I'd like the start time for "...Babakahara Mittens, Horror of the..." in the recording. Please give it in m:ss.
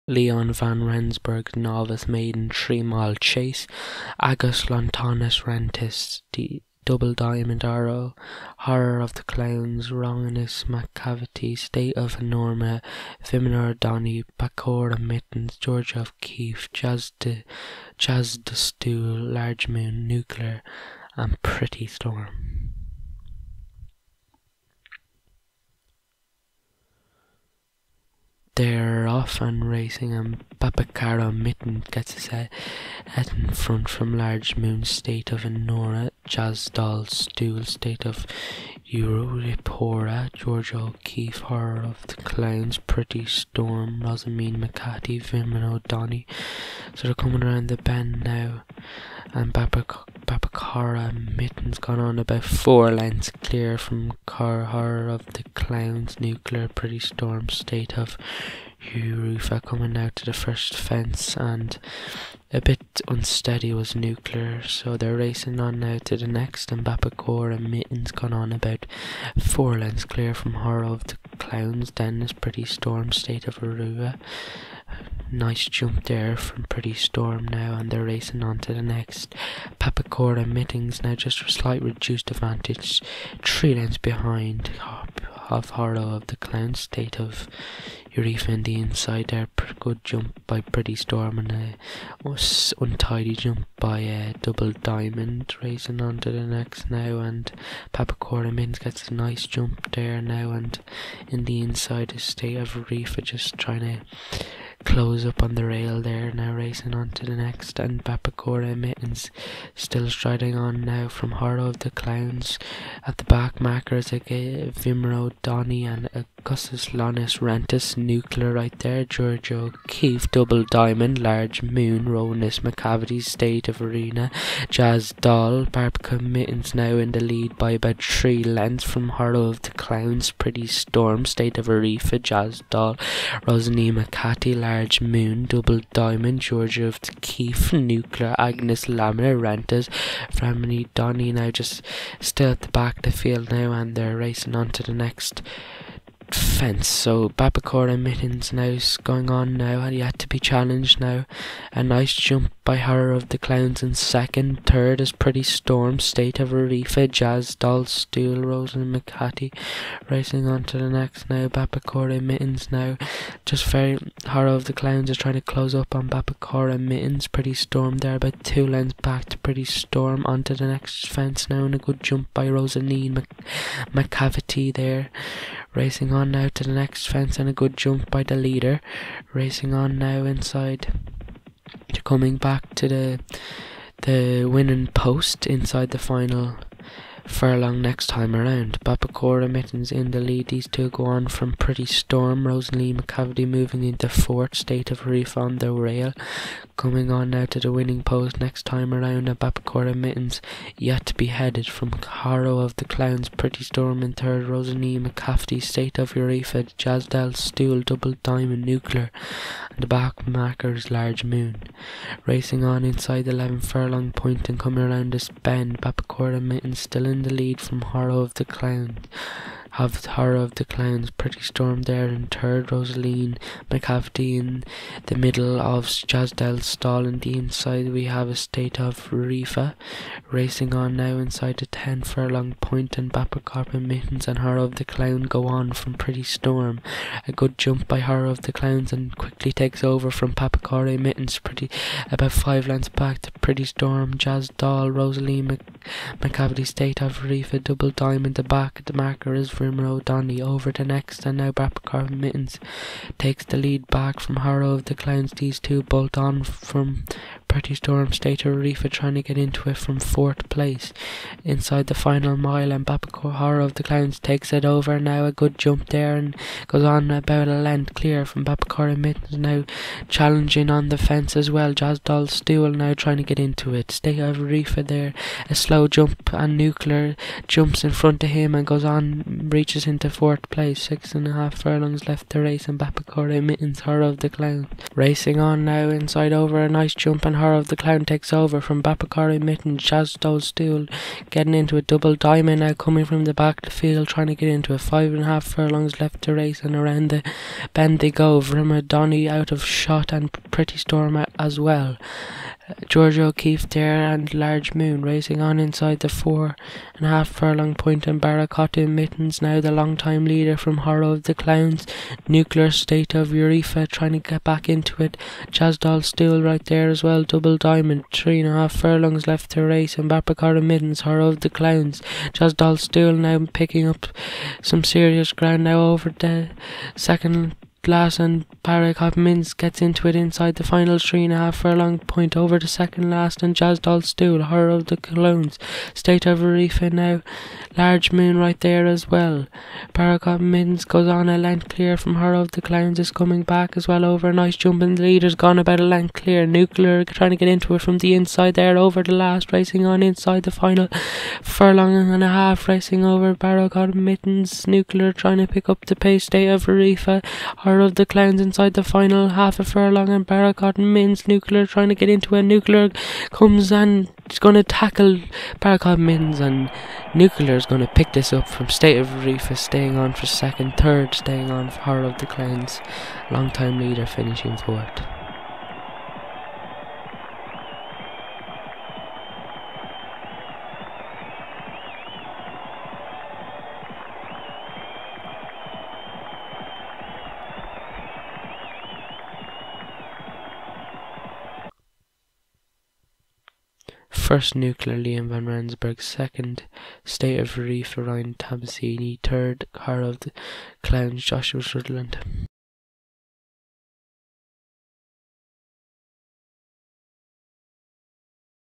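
4:42.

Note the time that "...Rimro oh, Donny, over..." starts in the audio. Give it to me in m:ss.
4:09.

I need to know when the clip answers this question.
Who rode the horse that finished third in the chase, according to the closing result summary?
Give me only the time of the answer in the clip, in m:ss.
6:41.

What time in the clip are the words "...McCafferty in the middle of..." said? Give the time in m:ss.
3:43.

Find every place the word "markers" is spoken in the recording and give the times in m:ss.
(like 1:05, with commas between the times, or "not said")
1:53, 3:30, 4:08.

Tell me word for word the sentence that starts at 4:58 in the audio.
Donny out of shot and Pretty Storm as well.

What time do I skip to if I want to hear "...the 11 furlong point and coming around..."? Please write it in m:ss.
3:33.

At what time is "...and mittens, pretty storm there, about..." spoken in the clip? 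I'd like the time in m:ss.
2:46.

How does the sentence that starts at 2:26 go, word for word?
So and mittens is going on now, and he had to be challenged now.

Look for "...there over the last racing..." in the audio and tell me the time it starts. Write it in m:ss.
5:48.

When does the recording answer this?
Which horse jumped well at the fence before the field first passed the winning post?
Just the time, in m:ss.
2:51.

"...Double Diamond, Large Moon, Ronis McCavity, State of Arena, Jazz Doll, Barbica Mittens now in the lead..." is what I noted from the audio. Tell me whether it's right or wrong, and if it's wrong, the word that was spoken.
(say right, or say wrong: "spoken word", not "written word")
right.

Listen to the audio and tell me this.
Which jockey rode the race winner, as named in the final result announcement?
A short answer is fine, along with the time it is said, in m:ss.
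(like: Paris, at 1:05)
Liam van Rensburg, at 6:34.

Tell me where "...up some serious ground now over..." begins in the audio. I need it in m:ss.
5:23.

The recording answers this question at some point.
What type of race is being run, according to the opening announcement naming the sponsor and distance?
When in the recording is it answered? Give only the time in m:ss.
0:01.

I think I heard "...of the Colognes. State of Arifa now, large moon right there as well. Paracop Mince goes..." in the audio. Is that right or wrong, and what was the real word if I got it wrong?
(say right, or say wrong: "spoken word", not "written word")
right.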